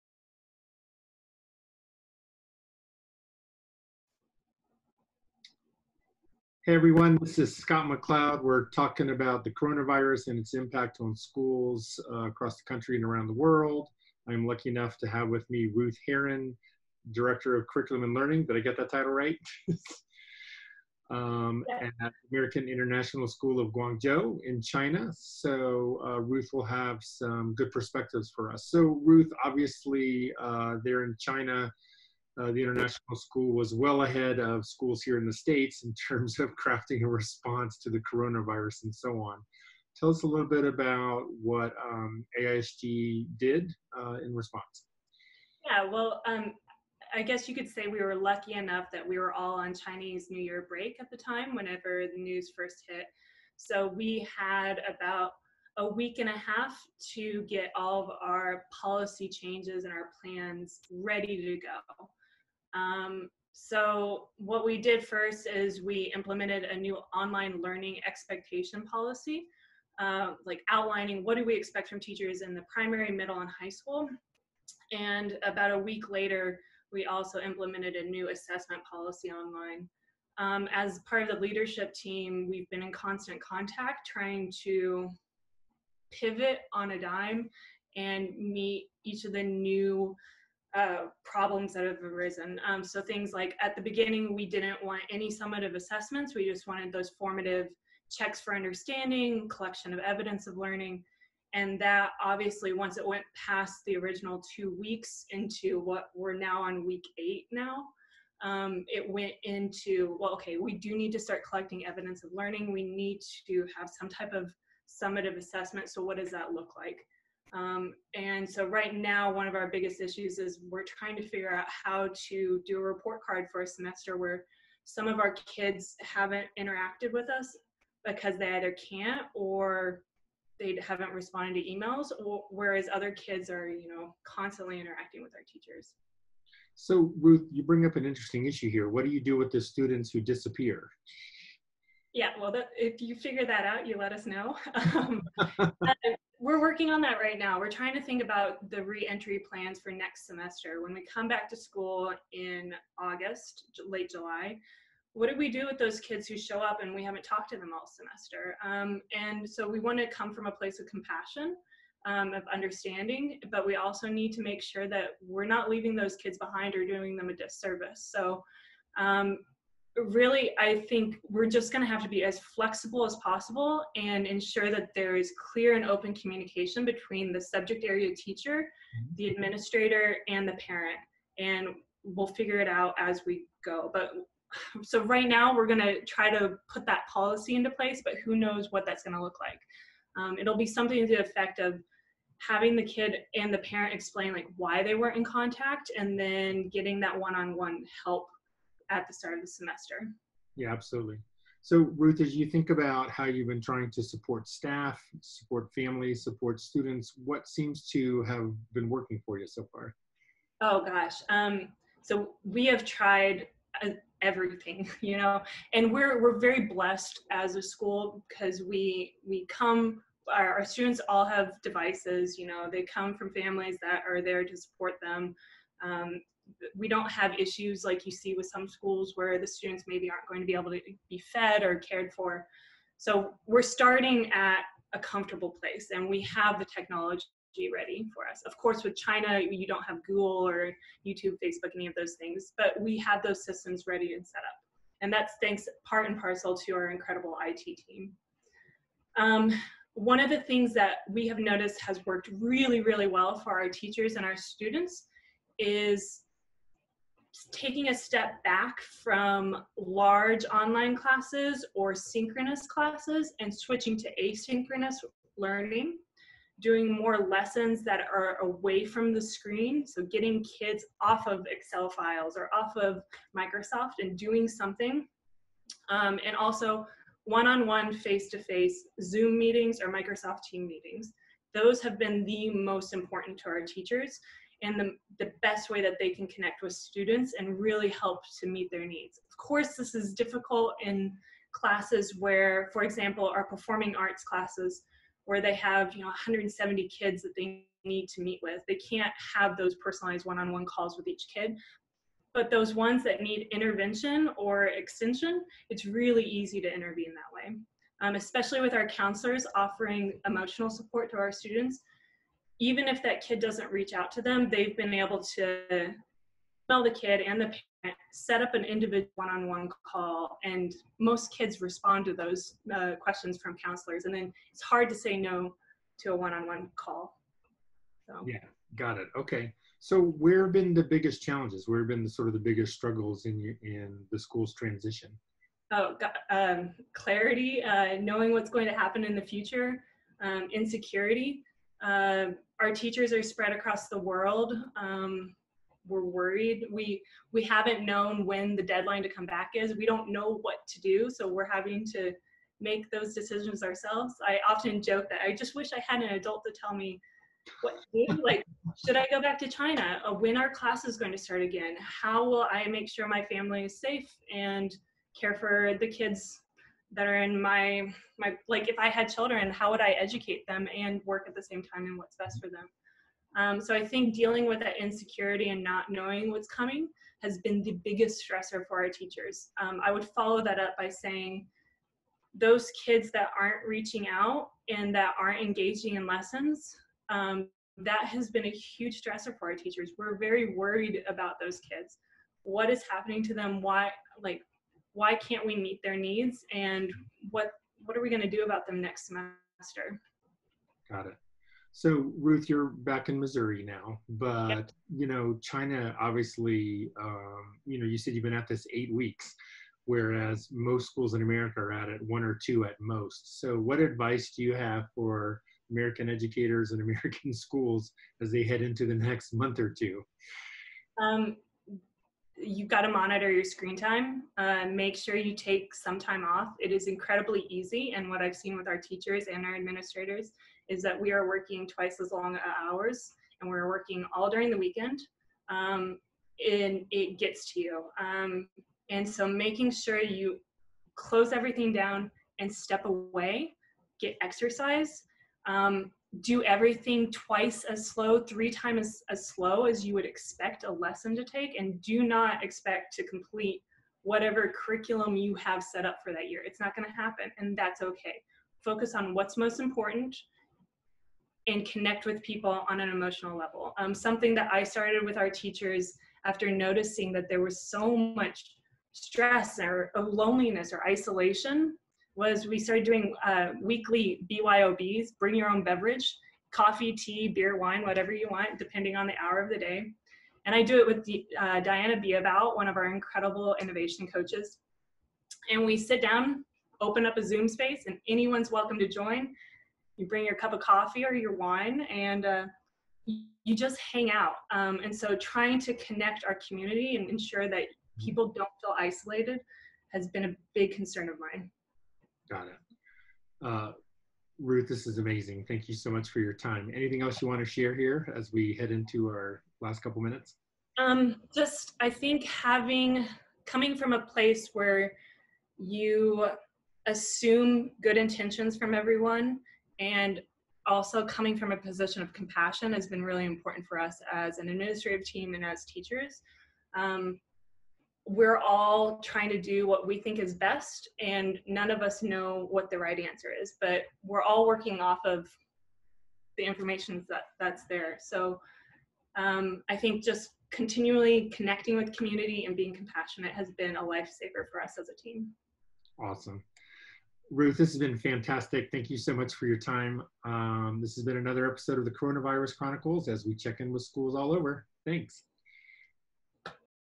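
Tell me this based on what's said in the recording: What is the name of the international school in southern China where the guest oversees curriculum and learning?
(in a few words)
American International School of Guangzhou.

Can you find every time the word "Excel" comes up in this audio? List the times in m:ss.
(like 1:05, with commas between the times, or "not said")
4:31.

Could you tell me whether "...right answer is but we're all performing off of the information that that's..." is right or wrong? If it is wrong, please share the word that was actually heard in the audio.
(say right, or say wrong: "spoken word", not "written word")
wrong: "working", not "performing".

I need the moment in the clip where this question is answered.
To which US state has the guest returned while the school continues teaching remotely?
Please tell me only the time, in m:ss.
6:43.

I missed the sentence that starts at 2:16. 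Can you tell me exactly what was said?
So Ruth, you bring up an interesting issue here.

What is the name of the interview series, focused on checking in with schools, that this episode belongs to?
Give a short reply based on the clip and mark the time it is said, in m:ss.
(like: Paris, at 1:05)
Coronavirus Chronicles, at 9:11.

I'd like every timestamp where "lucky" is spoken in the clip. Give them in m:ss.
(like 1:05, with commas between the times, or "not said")
0:14, 0:48.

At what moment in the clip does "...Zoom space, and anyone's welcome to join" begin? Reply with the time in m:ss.
8:07.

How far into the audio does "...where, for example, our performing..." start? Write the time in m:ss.
4:52.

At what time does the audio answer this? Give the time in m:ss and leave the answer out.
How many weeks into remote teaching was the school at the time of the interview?
1:46.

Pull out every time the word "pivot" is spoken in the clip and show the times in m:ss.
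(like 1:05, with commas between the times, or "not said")
1:26.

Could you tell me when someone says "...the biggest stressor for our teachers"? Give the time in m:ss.
6:17.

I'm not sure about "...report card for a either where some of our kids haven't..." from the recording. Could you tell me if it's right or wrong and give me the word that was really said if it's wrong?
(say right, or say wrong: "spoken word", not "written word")
wrong: "semester", not "either".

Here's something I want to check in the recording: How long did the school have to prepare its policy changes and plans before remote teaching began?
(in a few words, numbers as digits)
a week and a half.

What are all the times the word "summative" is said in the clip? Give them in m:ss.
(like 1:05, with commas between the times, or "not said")
1:35, 1:54.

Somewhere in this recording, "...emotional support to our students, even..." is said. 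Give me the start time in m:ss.
5:10.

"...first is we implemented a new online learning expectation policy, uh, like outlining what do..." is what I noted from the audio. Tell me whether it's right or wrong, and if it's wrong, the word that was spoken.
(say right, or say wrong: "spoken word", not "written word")
right.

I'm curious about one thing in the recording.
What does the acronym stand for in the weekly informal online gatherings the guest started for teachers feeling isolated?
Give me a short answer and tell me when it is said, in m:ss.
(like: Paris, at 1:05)
bring your own beverage, at 7:55.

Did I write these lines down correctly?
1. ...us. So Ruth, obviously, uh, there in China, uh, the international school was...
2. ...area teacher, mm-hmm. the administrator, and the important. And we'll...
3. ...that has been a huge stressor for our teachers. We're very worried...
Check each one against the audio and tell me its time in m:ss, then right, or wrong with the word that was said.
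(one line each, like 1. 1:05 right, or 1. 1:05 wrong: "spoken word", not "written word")
1. 0:28 right
2. 2:57 wrong: "parent", not "important"
3. 6:27 right.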